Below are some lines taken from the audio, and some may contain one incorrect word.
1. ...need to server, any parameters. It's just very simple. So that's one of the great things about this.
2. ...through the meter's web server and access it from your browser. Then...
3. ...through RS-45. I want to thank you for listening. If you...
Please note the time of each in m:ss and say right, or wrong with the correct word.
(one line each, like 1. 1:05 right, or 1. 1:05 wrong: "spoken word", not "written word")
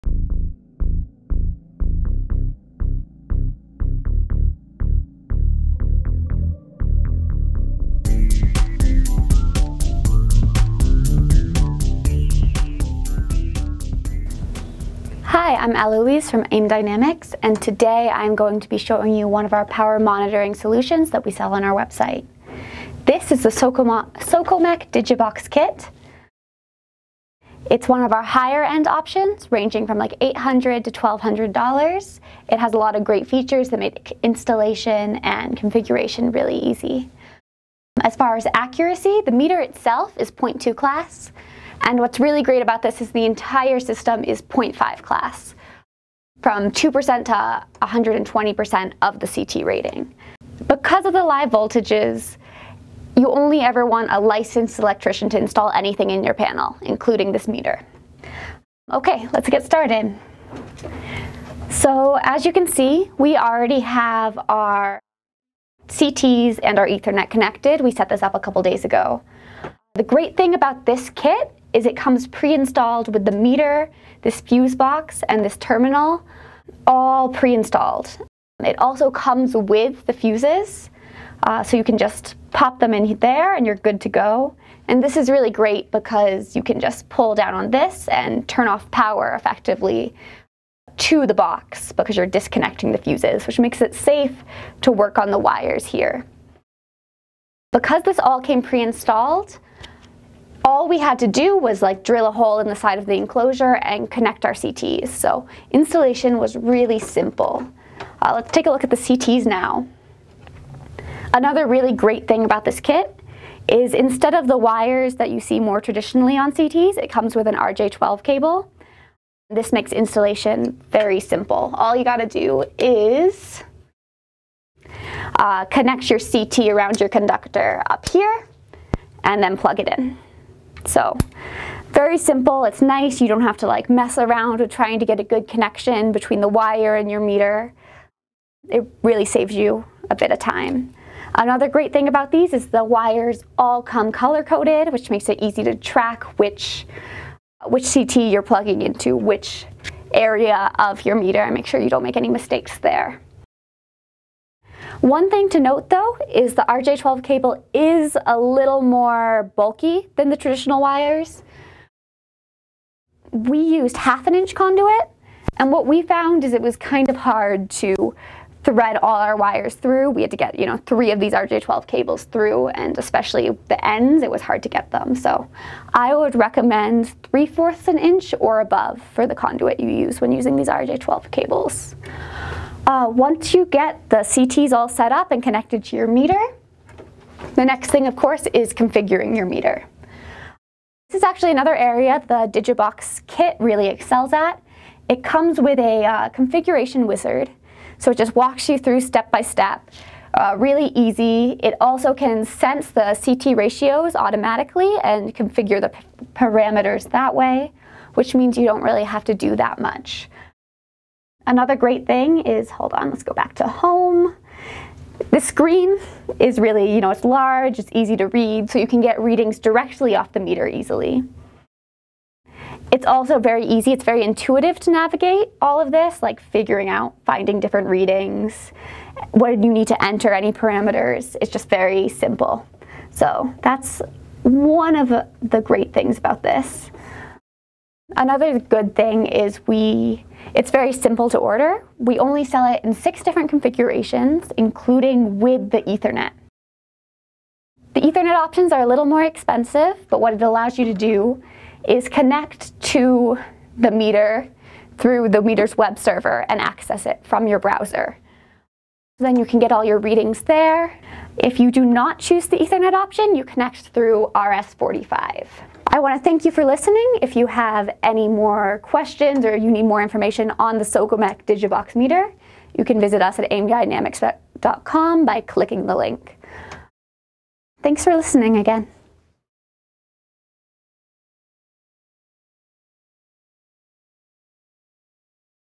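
1. 3:49 wrong: "enter", not "server"
2. 4:14 right
3. 4:23 right.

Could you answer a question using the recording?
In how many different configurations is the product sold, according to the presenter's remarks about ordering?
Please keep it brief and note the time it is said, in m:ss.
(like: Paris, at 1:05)
6, at 4:02.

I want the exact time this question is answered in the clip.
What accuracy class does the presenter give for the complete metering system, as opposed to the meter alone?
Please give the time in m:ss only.
0:44.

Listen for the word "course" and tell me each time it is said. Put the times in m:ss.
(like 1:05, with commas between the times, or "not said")
3:08.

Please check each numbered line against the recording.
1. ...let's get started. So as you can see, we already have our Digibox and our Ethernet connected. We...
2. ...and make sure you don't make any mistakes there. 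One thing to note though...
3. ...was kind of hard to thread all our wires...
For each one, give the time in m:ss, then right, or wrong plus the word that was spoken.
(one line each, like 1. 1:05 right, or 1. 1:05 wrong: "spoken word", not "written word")
1. 0:59 wrong: "CTs", not "Digibox"
2. 2:31 right
3. 2:46 right.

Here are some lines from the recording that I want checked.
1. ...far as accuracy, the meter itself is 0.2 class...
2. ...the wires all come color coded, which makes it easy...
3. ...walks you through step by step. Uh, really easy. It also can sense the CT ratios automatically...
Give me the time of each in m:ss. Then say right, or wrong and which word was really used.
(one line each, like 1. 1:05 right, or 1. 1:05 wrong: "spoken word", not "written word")
1. 0:38 right
2. 2:22 right
3. 3:18 right.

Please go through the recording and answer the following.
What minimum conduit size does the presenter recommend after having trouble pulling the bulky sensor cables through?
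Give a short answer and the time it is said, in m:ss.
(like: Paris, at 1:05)
3/4 inch, at 2:57.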